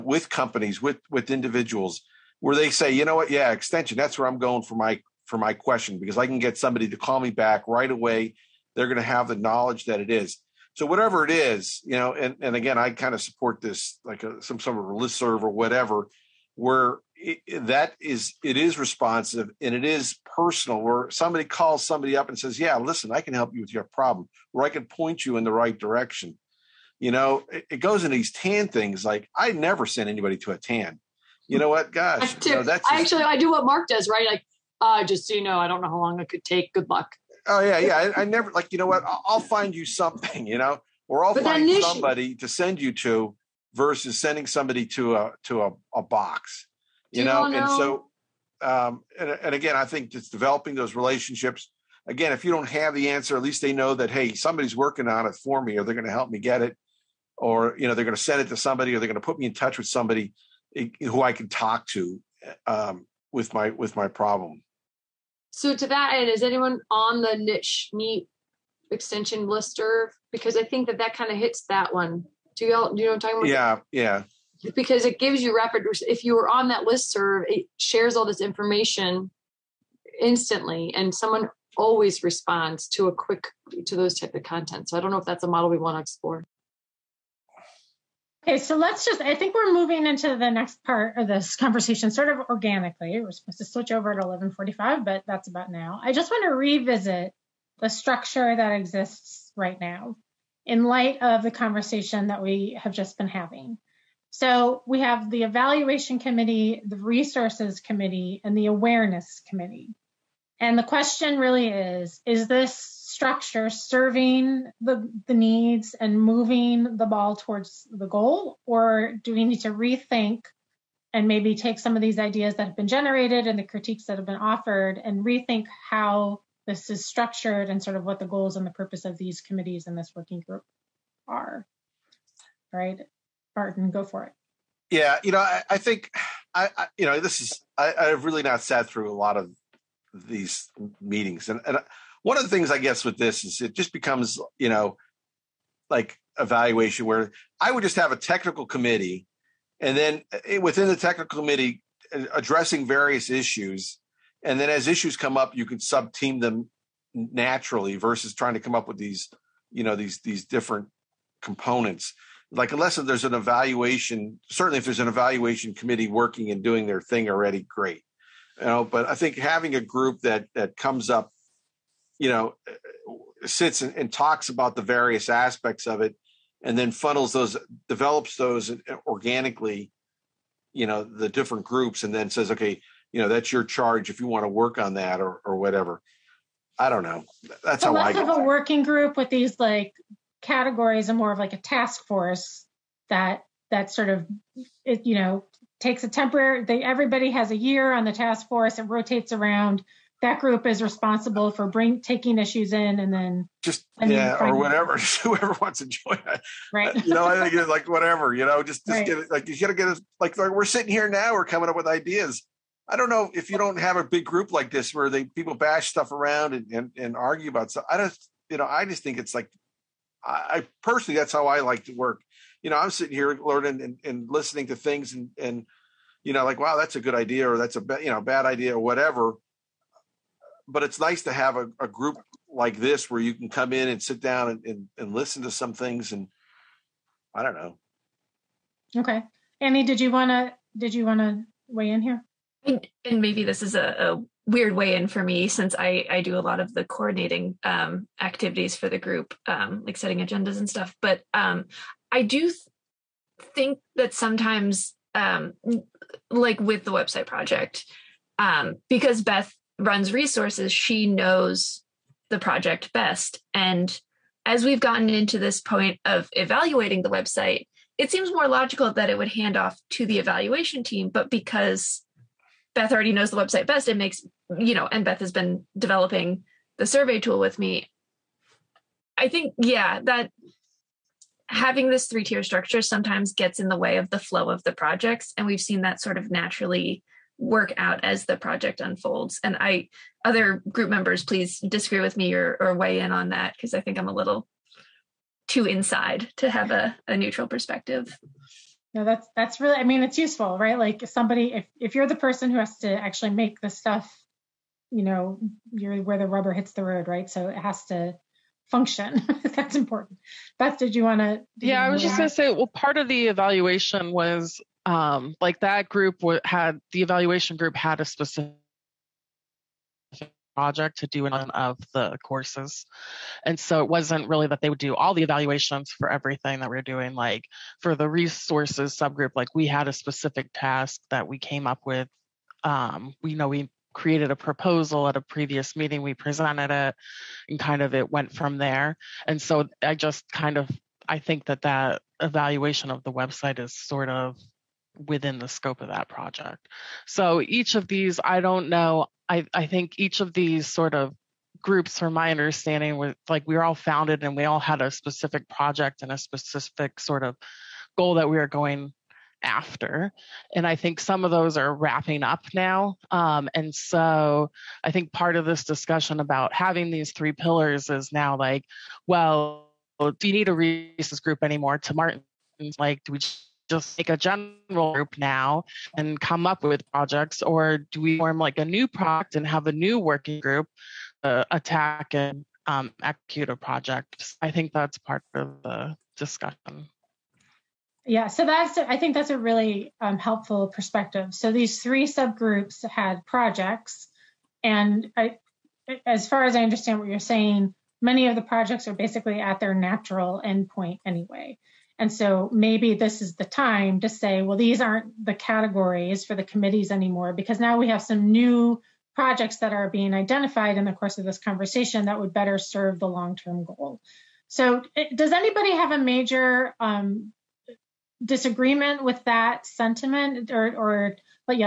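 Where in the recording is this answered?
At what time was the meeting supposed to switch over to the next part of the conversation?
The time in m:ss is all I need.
1:34.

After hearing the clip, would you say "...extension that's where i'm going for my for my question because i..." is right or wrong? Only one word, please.
right.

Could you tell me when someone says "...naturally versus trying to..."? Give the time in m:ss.
2:37.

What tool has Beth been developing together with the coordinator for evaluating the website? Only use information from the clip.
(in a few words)
survey tool.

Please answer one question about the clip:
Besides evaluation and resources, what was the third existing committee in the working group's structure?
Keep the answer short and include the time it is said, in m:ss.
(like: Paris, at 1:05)
awareness committee, at 1:48.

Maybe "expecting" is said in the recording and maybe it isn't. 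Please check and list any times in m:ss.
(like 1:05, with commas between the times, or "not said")
not said.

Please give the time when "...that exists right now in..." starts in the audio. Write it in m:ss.
1:38.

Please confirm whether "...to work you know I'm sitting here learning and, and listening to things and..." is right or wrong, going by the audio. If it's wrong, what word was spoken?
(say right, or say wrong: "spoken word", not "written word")
right.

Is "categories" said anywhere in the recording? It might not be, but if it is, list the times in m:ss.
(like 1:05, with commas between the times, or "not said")
3:10, 6:45.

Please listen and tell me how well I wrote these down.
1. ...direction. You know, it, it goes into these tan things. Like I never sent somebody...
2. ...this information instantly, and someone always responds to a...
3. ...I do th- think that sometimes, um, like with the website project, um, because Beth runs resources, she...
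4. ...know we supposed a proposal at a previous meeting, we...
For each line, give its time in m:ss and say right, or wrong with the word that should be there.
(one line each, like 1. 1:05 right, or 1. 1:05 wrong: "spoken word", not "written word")
1. 0:25 wrong: "anybody", not "somebody"
2. 1:18 right
3. 4:12 right
4. 5:33 wrong: "created", not "supposed".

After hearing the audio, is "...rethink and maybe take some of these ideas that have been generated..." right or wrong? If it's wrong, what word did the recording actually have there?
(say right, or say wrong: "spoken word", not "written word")
right.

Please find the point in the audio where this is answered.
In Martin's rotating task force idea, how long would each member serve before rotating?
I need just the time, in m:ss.
3:17.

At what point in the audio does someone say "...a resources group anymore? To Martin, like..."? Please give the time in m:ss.
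6:10.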